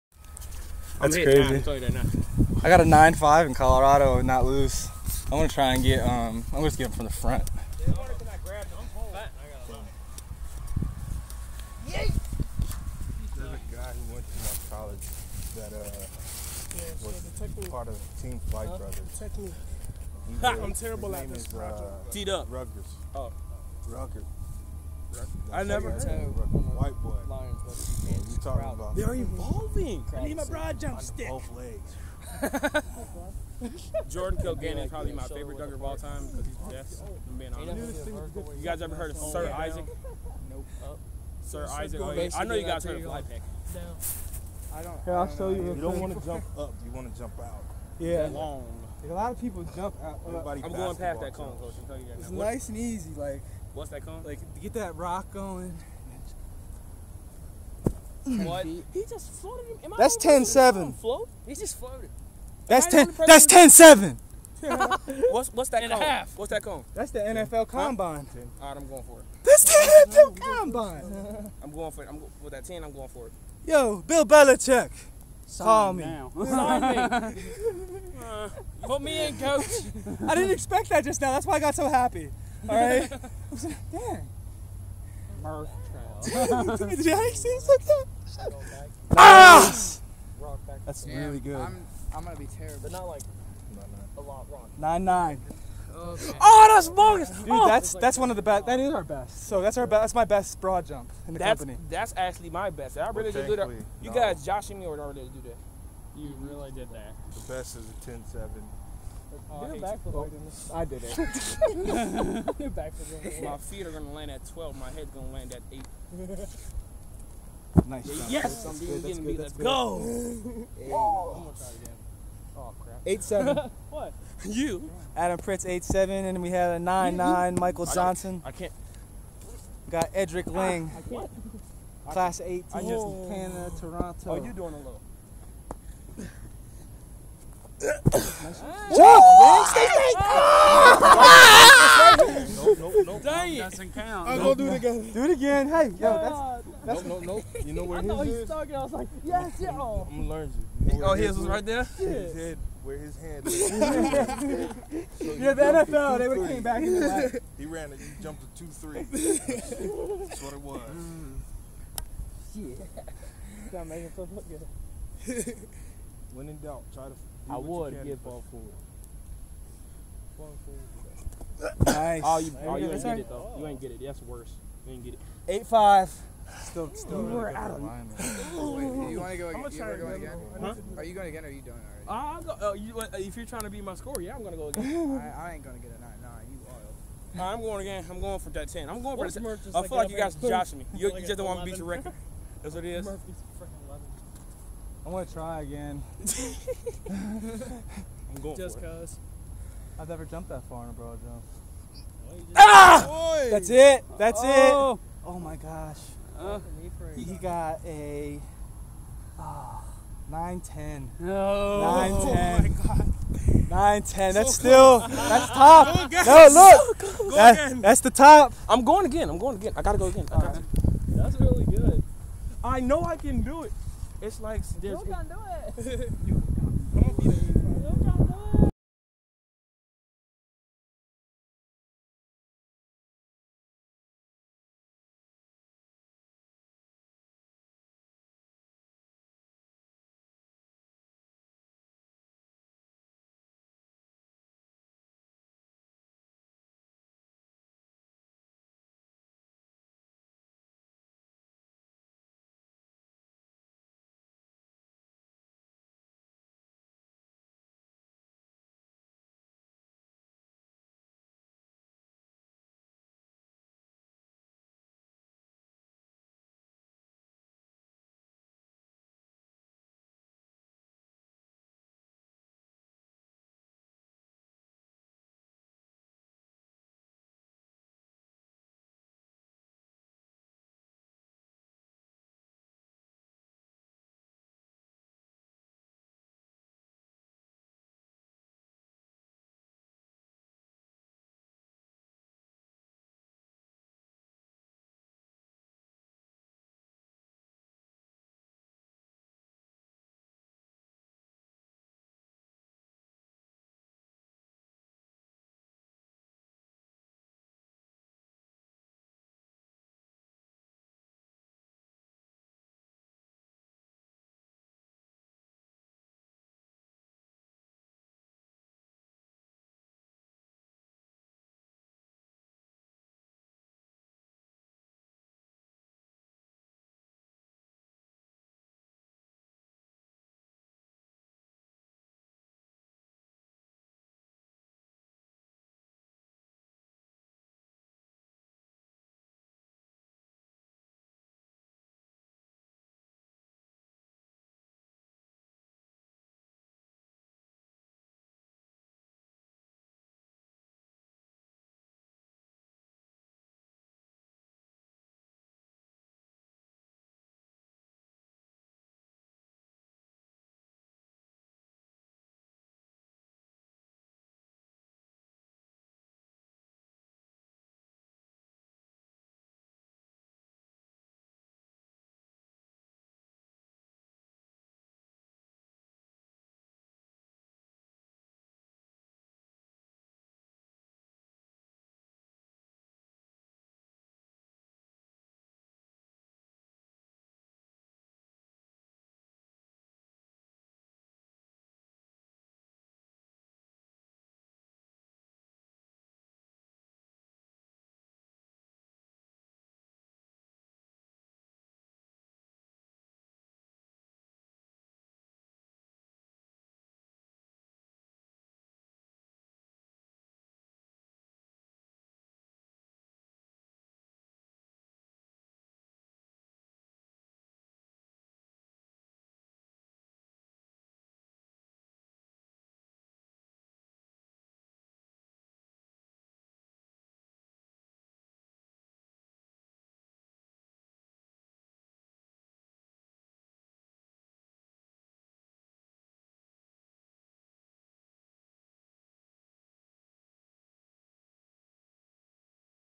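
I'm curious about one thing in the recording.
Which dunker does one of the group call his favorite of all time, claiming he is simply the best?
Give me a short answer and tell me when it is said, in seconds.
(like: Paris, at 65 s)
Jordan Kilganon, at 34 s.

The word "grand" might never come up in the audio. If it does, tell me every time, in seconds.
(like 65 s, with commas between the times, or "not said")
not said.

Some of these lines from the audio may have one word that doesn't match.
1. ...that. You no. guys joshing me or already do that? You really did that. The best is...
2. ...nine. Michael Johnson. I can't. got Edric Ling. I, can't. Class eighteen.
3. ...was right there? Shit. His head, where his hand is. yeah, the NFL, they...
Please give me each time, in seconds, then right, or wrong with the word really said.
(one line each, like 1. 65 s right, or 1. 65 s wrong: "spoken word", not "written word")
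1. 103 s right
2. 127 s right
3. 151 s right.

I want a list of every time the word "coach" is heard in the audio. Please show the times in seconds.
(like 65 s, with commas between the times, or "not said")
51 s, 79 s.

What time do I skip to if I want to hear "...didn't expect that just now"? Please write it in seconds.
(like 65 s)
80 s.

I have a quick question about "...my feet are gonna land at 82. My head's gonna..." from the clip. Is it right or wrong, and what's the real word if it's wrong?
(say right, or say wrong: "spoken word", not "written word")
wrong: "12", not "82".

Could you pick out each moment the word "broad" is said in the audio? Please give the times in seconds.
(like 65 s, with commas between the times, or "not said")
30 s, 100 s, 200 s.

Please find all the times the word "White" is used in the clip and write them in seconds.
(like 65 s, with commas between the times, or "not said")
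25 s.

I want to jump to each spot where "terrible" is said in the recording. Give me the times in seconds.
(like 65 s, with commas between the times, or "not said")
20 s, 92 s.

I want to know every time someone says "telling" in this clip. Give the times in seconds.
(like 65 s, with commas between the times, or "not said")
51 s.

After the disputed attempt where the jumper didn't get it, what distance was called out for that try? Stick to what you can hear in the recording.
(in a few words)
8-5.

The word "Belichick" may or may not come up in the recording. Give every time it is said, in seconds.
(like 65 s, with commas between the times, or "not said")
74 s.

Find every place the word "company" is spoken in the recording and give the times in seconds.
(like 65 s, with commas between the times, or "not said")
101 s.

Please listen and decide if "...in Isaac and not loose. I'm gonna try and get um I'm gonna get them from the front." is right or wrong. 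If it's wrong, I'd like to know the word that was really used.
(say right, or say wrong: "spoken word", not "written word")
wrong: "Colorado", not "Isaac".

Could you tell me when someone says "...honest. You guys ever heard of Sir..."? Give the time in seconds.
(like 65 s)
37 s.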